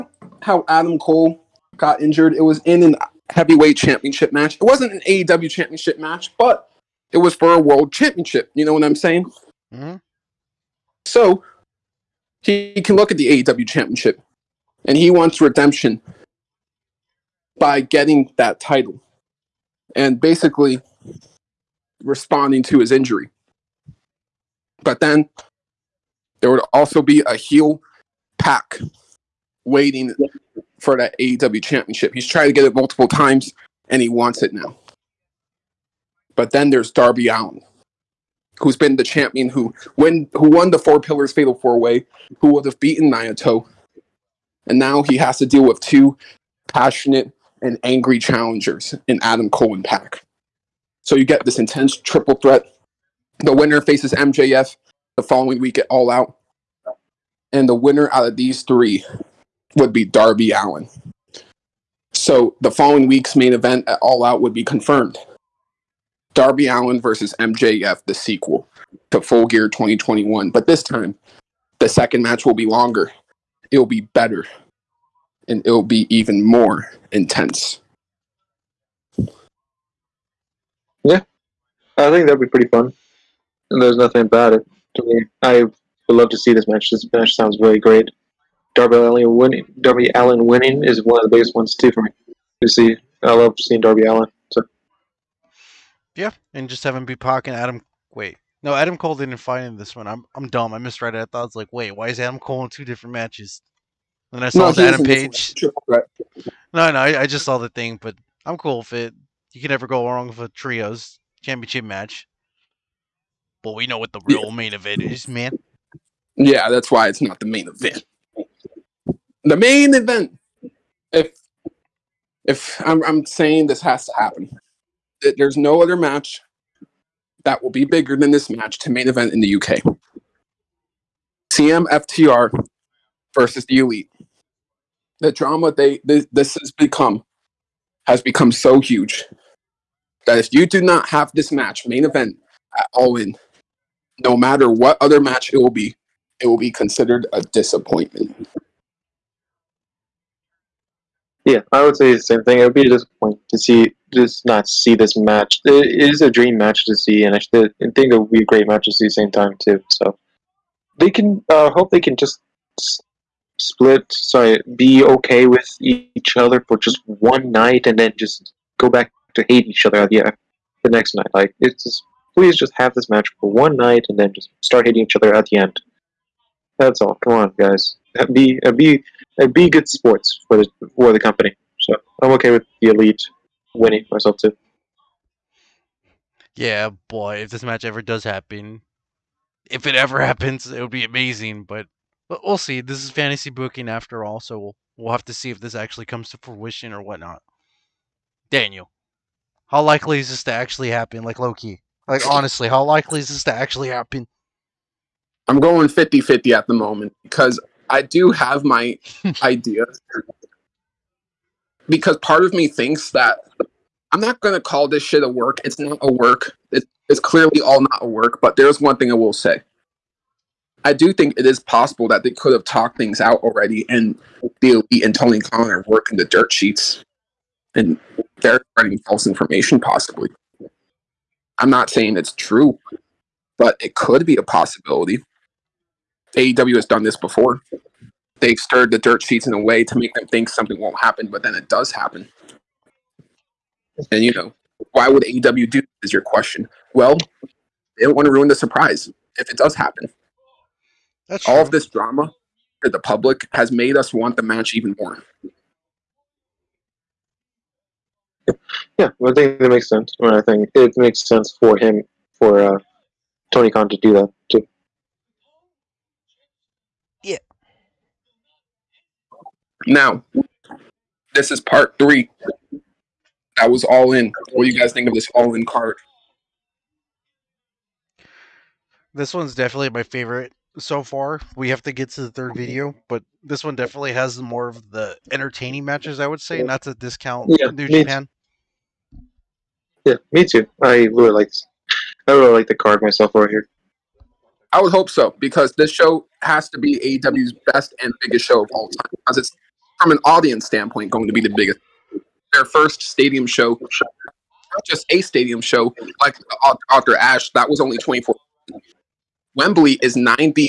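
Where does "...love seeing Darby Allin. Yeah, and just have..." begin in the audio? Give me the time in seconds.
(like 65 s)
93 s.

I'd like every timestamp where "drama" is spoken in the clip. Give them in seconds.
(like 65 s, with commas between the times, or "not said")
135 s, 251 s.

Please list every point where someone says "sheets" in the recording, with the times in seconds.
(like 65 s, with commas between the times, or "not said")
226 s, 239 s.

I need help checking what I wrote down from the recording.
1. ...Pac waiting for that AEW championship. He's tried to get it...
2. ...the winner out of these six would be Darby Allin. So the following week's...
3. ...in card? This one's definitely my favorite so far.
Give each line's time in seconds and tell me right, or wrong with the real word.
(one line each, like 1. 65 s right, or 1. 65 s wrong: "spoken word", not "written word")
1. 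28 s right
2. 57 s wrong: "three", not "six"
3. 275 s right.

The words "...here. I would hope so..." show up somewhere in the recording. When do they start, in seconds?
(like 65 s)
293 s.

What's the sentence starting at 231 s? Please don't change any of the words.
I'm not saying it's true, but it could be a possibility.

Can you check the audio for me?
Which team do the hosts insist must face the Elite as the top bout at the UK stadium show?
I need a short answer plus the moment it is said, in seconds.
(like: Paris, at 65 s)
CMFTR, at 131 s.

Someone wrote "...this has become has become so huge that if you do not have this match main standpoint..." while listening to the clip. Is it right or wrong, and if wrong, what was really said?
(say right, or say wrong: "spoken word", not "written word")
wrong: "event", not "standpoint".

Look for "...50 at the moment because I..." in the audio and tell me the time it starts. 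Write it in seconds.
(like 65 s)
206 s.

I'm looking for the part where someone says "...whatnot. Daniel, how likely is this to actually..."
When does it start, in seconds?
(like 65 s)
197 s.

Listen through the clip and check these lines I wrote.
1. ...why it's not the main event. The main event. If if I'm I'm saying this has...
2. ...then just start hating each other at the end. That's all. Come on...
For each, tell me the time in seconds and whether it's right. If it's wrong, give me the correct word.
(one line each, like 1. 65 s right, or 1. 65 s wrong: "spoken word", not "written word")
1. 116 s right
2. 174 s right.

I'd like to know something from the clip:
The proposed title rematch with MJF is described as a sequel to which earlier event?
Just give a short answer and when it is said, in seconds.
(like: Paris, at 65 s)
Full Gear 2021, at 69 s.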